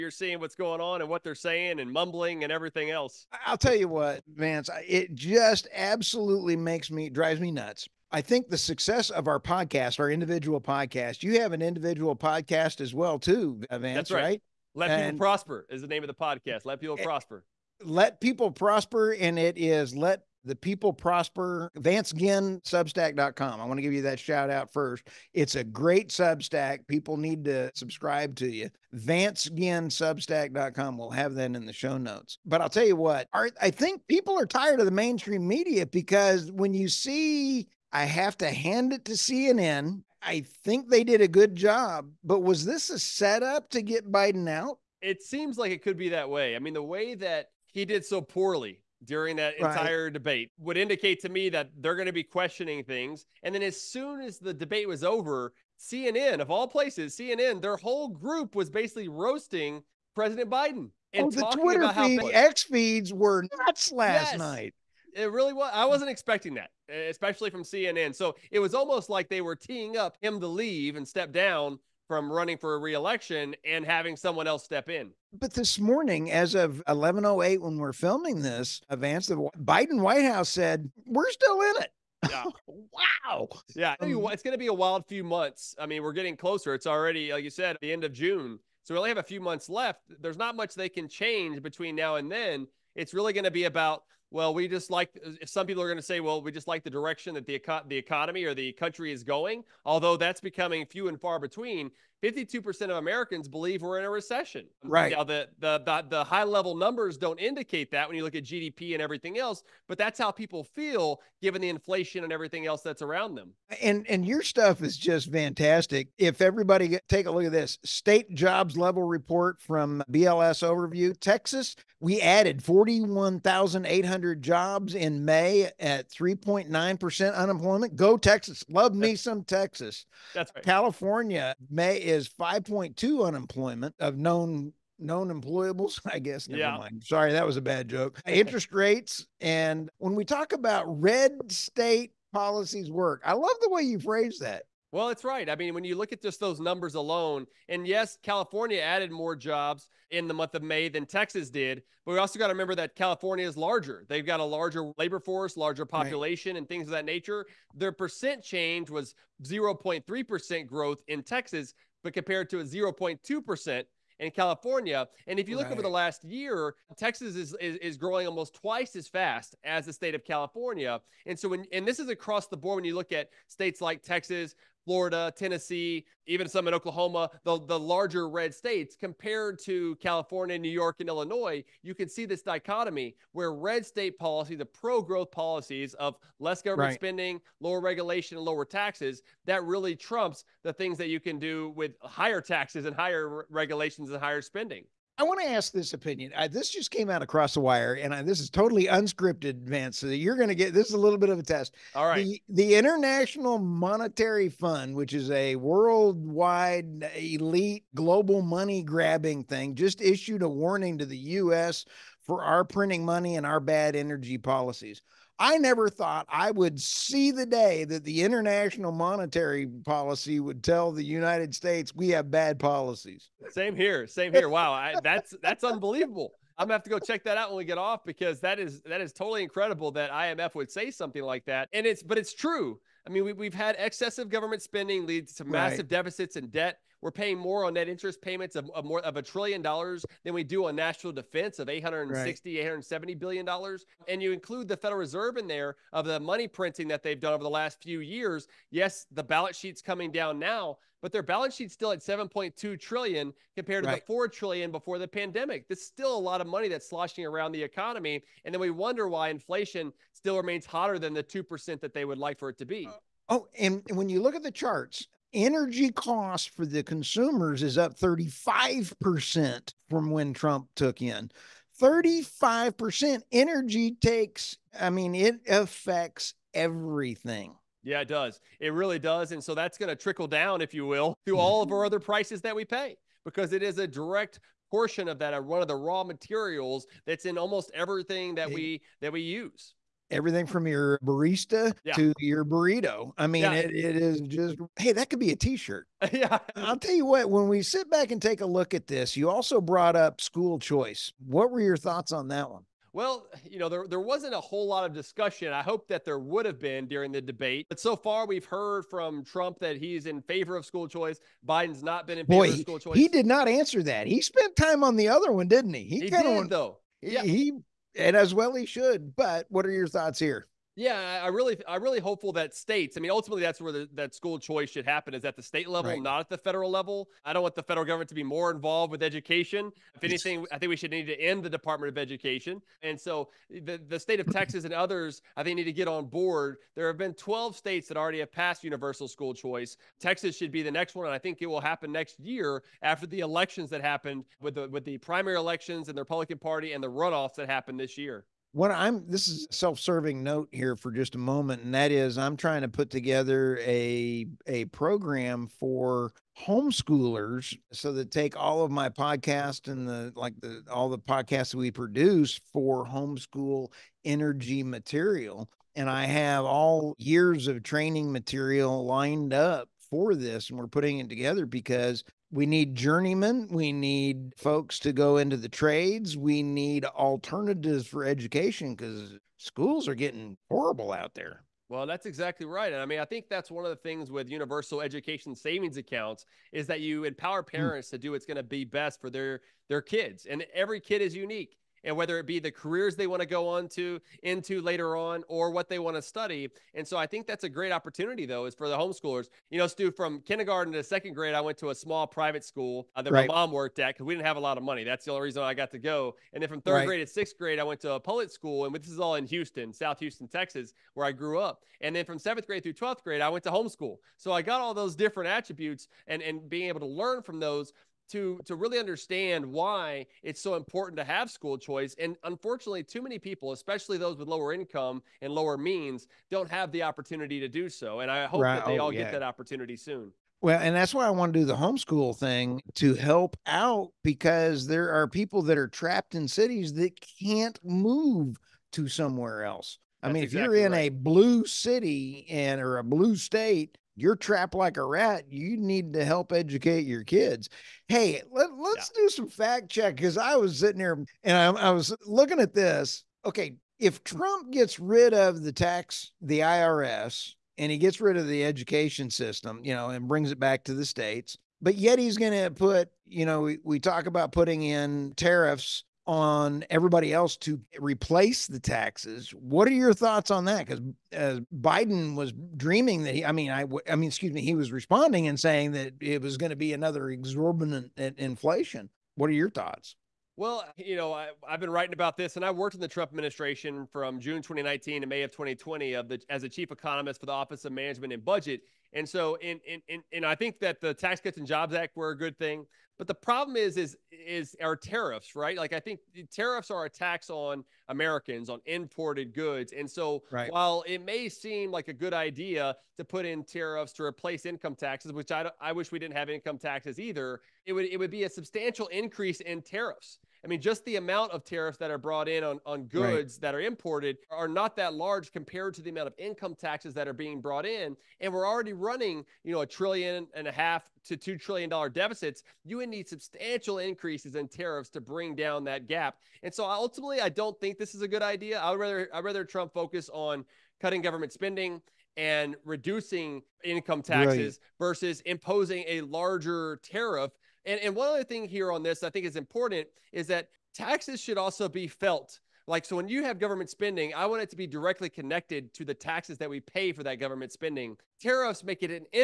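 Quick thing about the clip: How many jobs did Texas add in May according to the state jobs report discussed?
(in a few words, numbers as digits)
41,800.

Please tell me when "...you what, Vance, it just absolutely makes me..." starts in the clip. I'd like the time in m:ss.
0:03.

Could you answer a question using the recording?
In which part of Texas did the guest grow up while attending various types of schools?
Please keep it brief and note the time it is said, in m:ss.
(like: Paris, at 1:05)
South Houston, at 6:49.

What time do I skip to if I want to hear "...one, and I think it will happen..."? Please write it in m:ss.
5:40.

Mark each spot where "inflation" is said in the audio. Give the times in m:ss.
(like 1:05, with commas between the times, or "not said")
1:51, 4:19, 7:57.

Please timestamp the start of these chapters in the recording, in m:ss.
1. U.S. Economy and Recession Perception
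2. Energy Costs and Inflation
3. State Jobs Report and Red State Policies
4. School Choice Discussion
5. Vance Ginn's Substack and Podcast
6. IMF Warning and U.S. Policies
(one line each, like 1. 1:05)
1. 1:23
2. 4:24
3. 2:25
4. 5:03
5. 0:15
6. 3:43.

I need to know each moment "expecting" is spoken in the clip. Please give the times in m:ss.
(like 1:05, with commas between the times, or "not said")
1:06.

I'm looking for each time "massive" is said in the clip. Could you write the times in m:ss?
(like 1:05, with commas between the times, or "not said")
3:55.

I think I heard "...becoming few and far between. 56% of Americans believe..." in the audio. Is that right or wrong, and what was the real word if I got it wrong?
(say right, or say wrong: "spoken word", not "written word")
wrong: "52", not "56".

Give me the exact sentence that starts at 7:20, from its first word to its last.
a blue city and or a blue state you're trapped like a rat.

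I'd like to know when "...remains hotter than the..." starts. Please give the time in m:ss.
4:20.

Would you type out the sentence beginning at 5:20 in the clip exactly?
Yeah, I really, I really hopeful that states.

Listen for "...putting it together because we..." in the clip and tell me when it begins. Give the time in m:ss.
6:10.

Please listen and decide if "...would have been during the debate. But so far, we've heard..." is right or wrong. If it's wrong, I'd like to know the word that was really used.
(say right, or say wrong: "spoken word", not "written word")
right.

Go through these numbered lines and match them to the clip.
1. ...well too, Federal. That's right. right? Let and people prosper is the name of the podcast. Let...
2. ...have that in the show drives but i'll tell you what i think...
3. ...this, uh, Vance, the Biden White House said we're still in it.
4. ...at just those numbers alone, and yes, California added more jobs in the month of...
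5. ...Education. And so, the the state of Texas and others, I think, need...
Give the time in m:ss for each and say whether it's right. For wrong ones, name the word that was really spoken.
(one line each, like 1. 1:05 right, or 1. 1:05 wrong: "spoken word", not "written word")
1. 0:12 wrong: "Vance", not "Federal"
2. 0:31 wrong: "notes", not "drives"
3. 1:18 right
4. 2:26 right
5. 5:31 right.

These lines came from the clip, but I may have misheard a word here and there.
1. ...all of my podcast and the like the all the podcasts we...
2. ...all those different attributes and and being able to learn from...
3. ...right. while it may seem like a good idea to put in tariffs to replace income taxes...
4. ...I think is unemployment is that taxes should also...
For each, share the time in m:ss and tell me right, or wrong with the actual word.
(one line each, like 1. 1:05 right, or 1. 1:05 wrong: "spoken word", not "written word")
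1. 5:58 right
2. 6:54 right
3. 8:20 right
4. 8:59 wrong: "important", not "unemployment".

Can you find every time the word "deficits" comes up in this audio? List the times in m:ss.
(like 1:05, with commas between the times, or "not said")
3:55, 8:41.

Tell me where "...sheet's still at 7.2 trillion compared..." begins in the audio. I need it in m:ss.
4:11.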